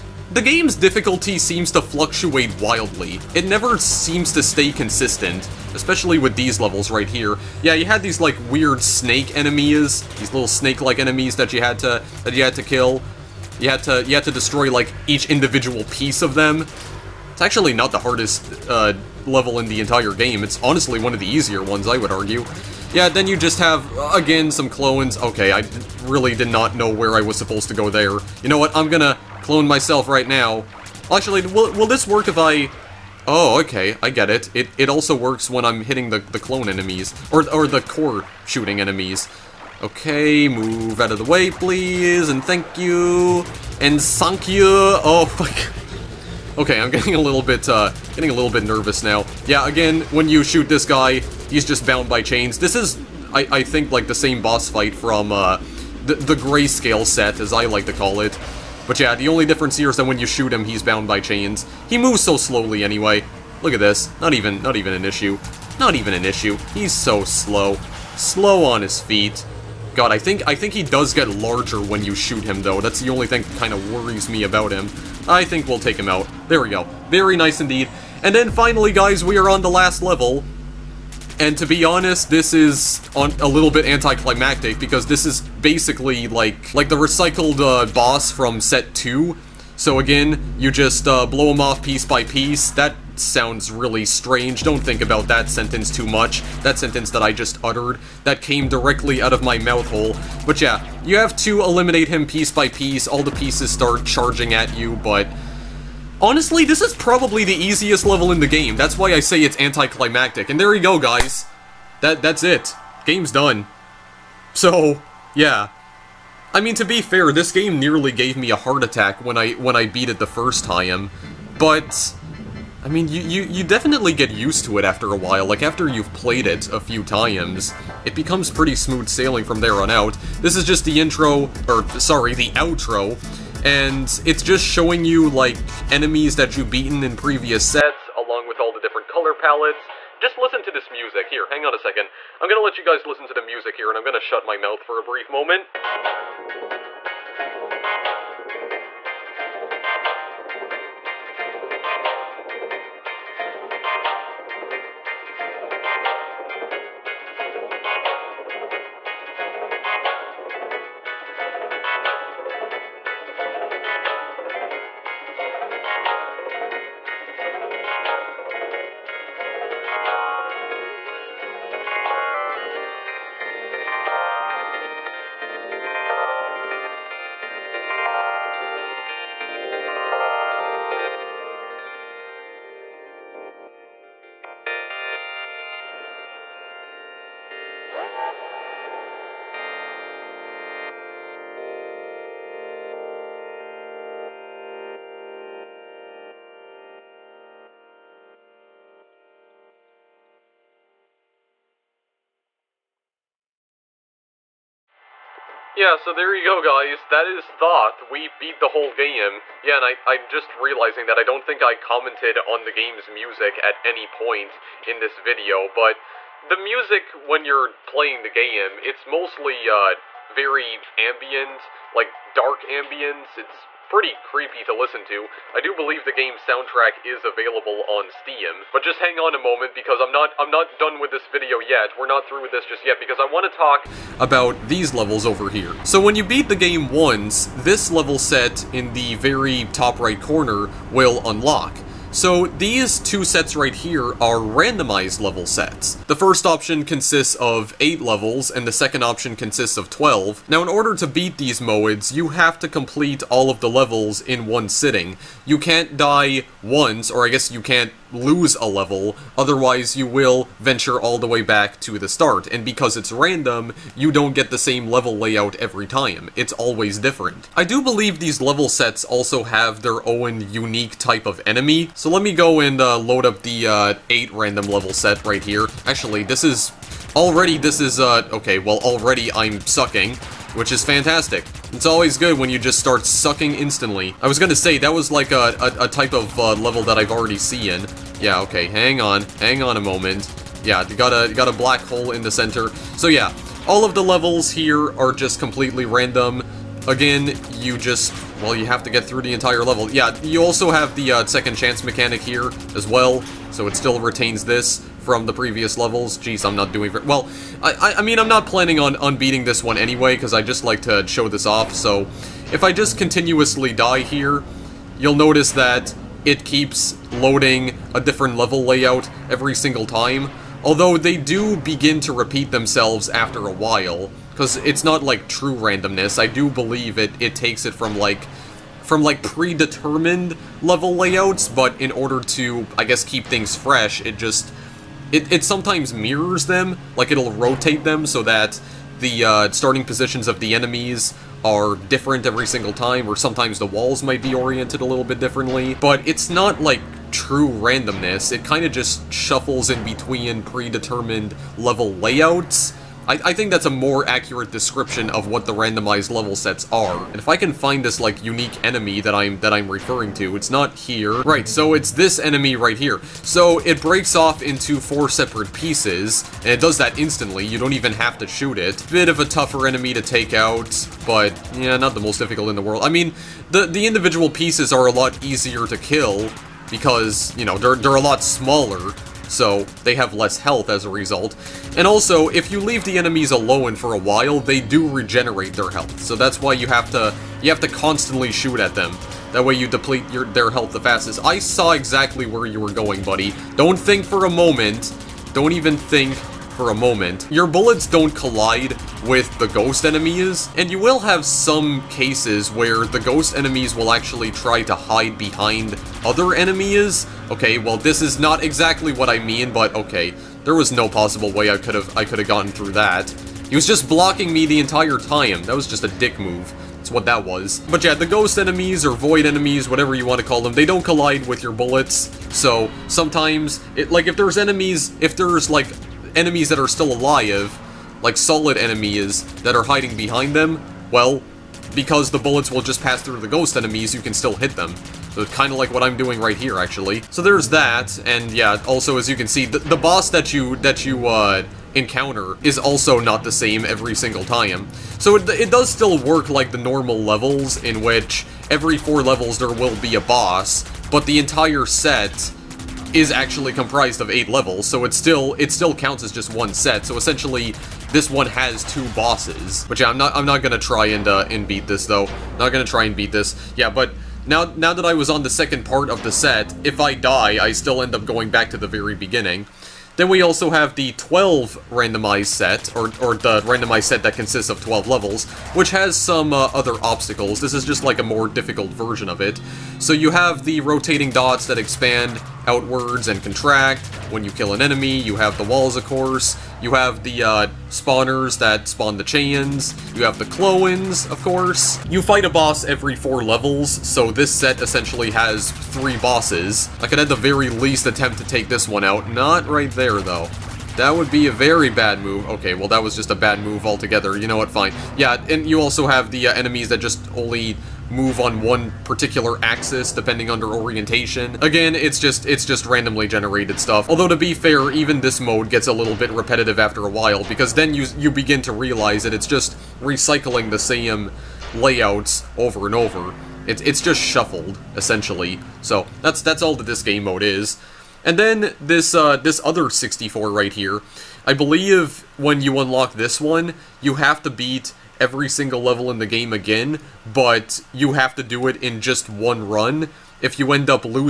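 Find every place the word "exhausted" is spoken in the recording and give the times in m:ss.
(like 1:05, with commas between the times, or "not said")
not said.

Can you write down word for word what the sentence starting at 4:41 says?
It's always good when you just start sucking instantly.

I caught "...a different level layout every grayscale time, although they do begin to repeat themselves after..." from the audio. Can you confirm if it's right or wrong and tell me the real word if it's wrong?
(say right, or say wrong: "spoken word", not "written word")
wrong: "single", not "grayscale".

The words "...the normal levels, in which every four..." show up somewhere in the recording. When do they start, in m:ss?
7:26.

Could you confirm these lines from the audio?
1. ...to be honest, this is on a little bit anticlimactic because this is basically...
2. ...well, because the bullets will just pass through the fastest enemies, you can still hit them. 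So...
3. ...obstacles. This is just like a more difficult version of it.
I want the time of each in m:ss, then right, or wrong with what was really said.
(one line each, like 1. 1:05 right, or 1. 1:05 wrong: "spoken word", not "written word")
1. 1:21 right
2. 7:10 wrong: "ghost", not "fastest"
3. 7:56 right.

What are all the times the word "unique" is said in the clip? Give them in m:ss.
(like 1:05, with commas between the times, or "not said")
4:30, 5:58.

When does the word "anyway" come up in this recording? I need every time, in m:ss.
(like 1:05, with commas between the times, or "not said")
1:02, 5:09.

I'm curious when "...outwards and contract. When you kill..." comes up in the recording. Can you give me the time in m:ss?
8:02.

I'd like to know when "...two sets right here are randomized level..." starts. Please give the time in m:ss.
4:02.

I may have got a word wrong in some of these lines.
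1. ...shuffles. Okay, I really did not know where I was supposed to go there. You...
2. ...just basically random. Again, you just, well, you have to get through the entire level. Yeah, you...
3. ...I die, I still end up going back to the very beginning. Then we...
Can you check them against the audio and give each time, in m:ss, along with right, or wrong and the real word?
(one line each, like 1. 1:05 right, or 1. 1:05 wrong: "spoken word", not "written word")
1. 0:24 wrong: "clones", not "shuffles"
2. 4:55 wrong: "completely", not "basically"
3. 7:46 right.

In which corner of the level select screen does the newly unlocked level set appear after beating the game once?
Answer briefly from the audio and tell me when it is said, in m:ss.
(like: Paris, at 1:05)
Top right, at 3:59.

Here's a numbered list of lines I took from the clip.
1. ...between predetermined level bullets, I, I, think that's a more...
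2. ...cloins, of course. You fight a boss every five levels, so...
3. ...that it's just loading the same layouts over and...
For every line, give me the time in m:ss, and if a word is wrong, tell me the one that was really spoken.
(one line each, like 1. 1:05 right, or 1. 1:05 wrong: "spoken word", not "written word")
1. 5:49 wrong: "layouts", not "bullets"
2. 8:10 wrong: "four", not "five"
3. 8:39 wrong: "recycling", not "loading".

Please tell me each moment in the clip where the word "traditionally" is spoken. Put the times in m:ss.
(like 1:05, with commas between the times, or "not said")
not said.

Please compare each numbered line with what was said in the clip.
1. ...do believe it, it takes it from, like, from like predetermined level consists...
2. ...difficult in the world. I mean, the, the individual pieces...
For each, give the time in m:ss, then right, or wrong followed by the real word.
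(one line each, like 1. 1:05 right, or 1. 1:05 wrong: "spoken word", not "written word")
1. 5:26 wrong: "layouts", not "consists"
2. 6:12 right.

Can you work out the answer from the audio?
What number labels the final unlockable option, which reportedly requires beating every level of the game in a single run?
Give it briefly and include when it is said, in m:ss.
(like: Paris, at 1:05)
64, at 8:49.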